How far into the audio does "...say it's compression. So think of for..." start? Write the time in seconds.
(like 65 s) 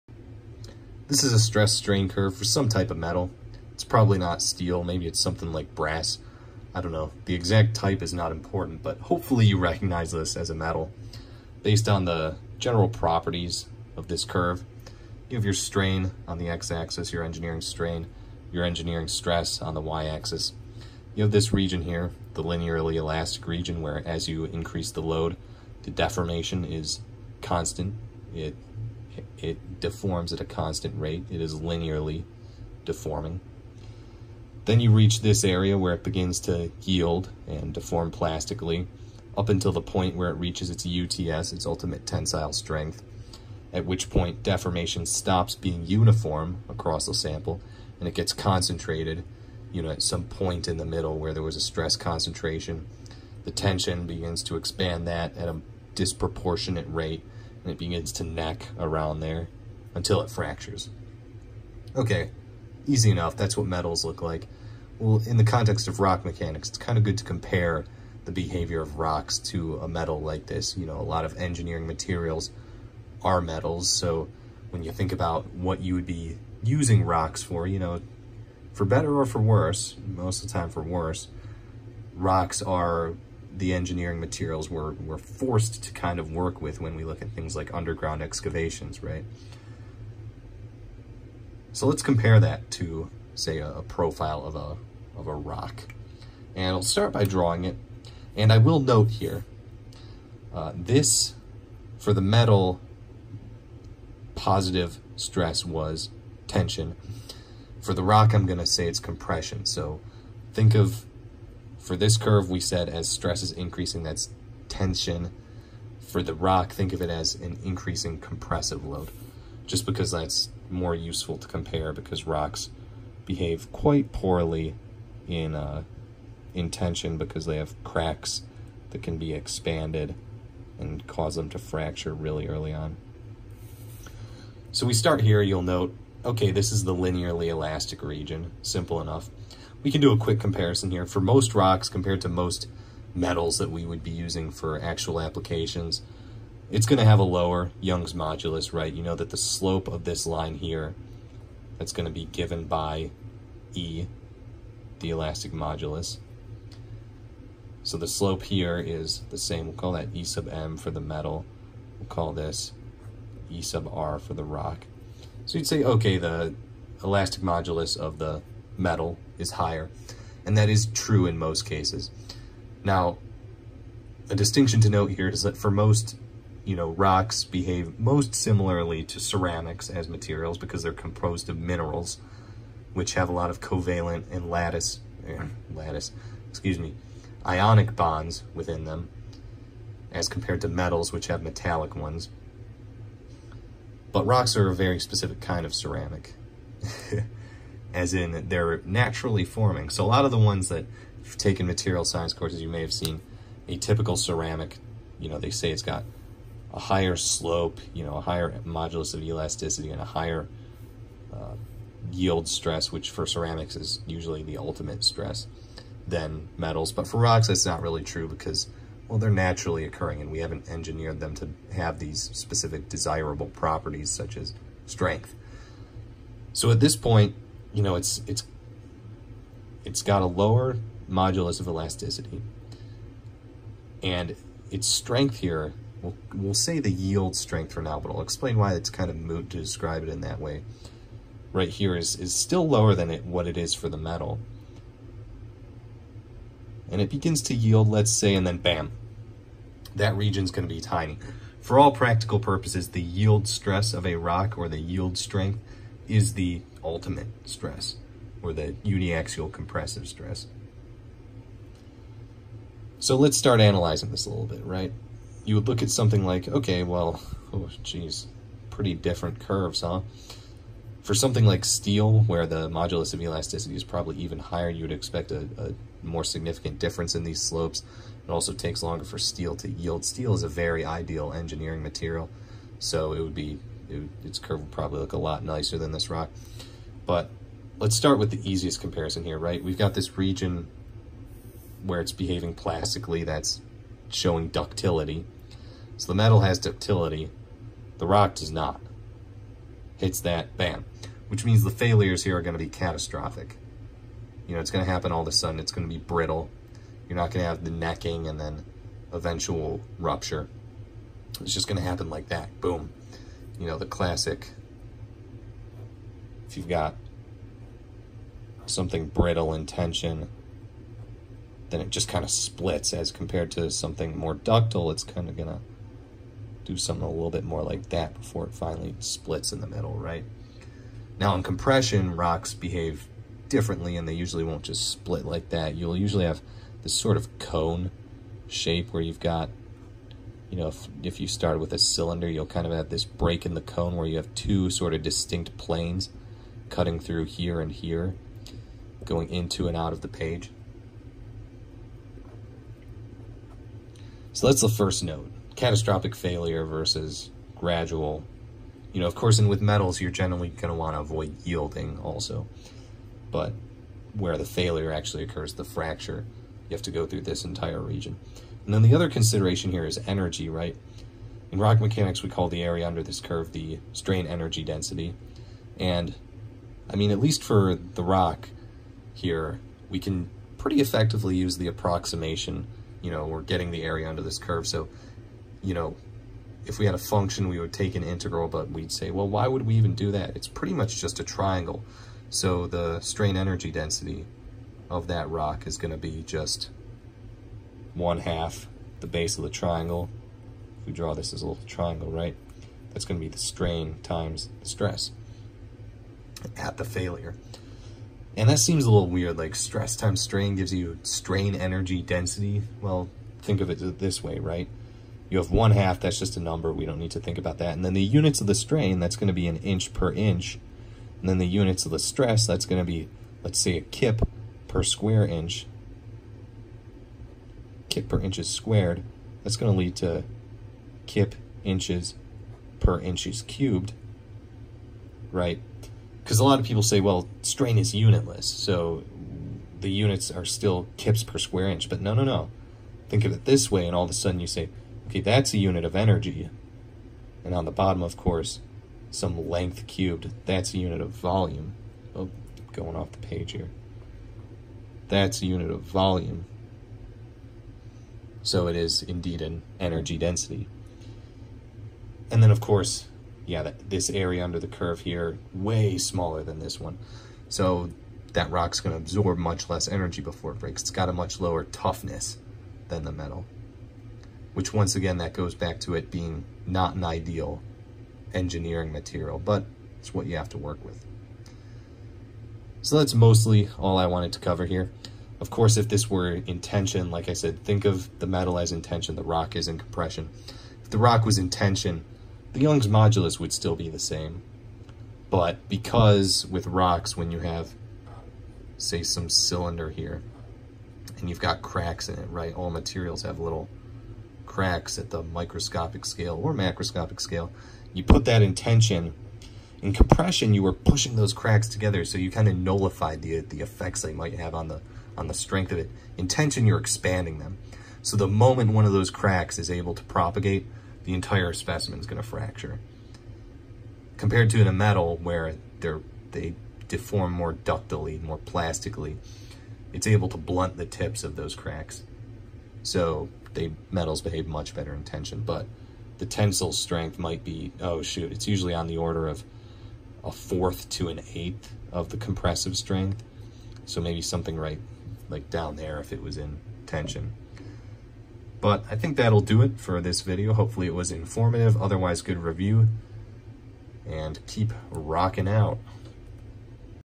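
108 s.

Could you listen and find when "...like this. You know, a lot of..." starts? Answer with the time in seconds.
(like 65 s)
70 s.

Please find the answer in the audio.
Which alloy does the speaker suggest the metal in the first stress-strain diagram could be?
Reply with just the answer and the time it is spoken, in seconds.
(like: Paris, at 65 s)
Brass, at 5 s.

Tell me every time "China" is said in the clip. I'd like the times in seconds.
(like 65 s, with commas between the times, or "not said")
not said.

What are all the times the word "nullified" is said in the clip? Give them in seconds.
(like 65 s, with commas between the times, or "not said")
512 s.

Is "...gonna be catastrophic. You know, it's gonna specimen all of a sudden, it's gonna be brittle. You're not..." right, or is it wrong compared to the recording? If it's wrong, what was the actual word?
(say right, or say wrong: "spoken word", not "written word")
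wrong: "happen", not "specimen".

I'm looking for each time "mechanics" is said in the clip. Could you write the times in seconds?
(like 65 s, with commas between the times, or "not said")
66 s, 371 s.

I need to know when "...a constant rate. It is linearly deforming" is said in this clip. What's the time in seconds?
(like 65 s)
30 s.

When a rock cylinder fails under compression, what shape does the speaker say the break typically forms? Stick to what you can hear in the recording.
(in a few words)
Cone shape.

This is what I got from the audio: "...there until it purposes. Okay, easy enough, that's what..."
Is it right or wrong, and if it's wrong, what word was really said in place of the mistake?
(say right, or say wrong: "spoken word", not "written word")
wrong: "fractures", not "purposes".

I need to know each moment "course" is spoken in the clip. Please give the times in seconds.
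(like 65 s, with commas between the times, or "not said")
202 s, 359 s, 448 s, 462 s, 485 s.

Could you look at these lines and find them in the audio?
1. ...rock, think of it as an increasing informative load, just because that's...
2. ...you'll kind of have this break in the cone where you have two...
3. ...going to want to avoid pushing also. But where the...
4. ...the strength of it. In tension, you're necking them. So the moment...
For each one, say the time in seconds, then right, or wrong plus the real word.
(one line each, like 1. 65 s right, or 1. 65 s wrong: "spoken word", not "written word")
1. 116 s wrong: "compressive", not "informative"
2. 342 s right
3. 360 s wrong: "yielding", not "pushing"
4. 515 s wrong: "expanding", not "necking".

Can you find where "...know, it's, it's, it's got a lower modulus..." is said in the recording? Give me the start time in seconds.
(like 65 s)
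227 s.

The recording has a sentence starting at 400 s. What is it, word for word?
If we draw this as a little triangle, right?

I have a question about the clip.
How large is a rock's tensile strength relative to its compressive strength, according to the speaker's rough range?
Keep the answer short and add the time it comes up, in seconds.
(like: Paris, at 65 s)
A fourth to an eighth, at 540 s.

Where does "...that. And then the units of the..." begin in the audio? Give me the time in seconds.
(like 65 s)
417 s.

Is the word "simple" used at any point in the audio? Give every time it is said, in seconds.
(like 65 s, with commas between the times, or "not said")
138 s.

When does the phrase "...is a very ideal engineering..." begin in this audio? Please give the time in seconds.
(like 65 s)
280 s.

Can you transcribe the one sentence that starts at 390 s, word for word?
It's pretty much just a triangle.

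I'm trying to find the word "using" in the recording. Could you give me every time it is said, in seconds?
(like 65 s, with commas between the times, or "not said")
76 s, 144 s.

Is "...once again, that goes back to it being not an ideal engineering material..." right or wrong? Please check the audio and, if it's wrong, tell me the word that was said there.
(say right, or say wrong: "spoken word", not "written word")
right.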